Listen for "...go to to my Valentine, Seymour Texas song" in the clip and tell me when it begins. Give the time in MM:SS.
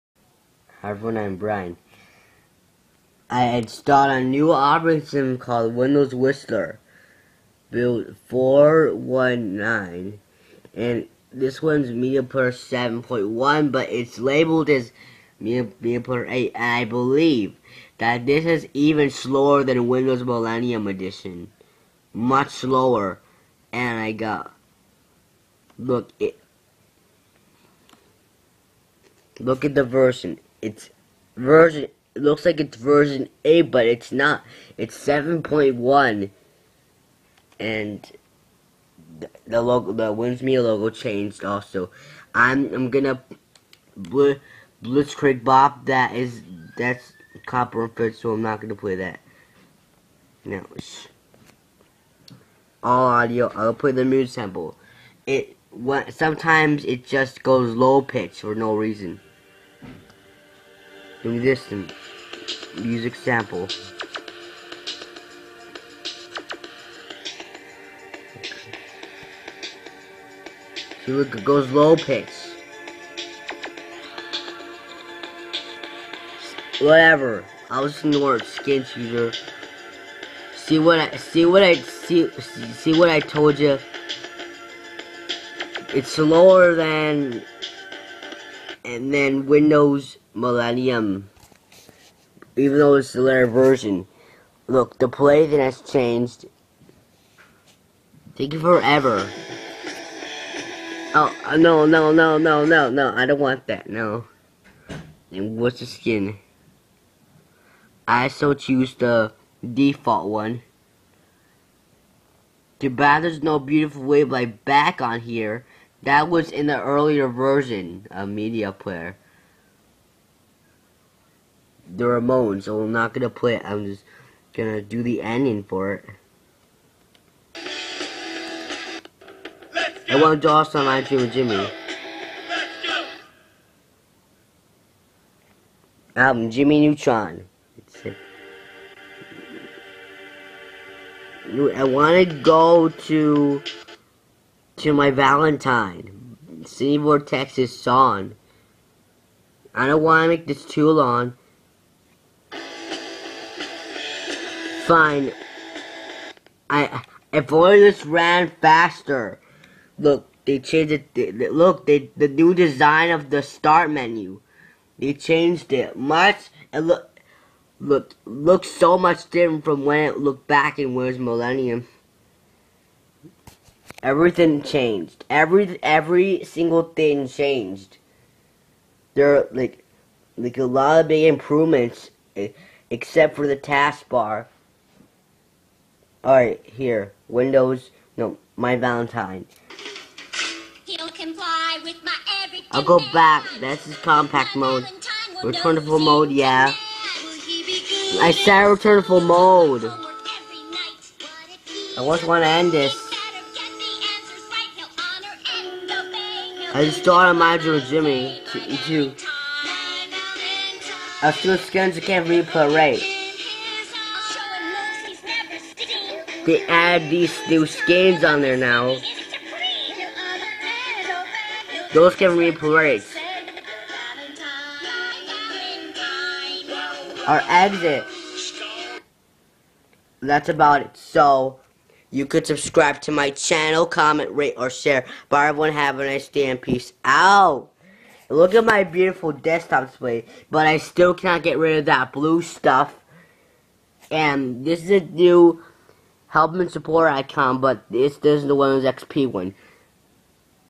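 02:22.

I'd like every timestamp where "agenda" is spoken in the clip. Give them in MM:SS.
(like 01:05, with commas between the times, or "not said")
not said.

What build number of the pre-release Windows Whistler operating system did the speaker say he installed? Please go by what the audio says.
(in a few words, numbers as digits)
419.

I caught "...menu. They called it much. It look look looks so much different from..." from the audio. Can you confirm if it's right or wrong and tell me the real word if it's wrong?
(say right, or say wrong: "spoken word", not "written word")
wrong: "changed", not "called".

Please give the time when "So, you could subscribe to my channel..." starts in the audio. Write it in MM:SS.
03:50.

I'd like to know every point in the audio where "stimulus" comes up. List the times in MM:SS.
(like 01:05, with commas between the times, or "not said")
not said.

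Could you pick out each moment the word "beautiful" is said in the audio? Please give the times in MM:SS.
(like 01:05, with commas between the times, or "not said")
01:53, 03:58.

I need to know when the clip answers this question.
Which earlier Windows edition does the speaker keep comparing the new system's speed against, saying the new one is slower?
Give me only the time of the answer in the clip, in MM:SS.
00:19.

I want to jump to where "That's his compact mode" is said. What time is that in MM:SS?
03:13.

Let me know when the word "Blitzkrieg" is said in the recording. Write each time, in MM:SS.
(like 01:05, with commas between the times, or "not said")
00:44.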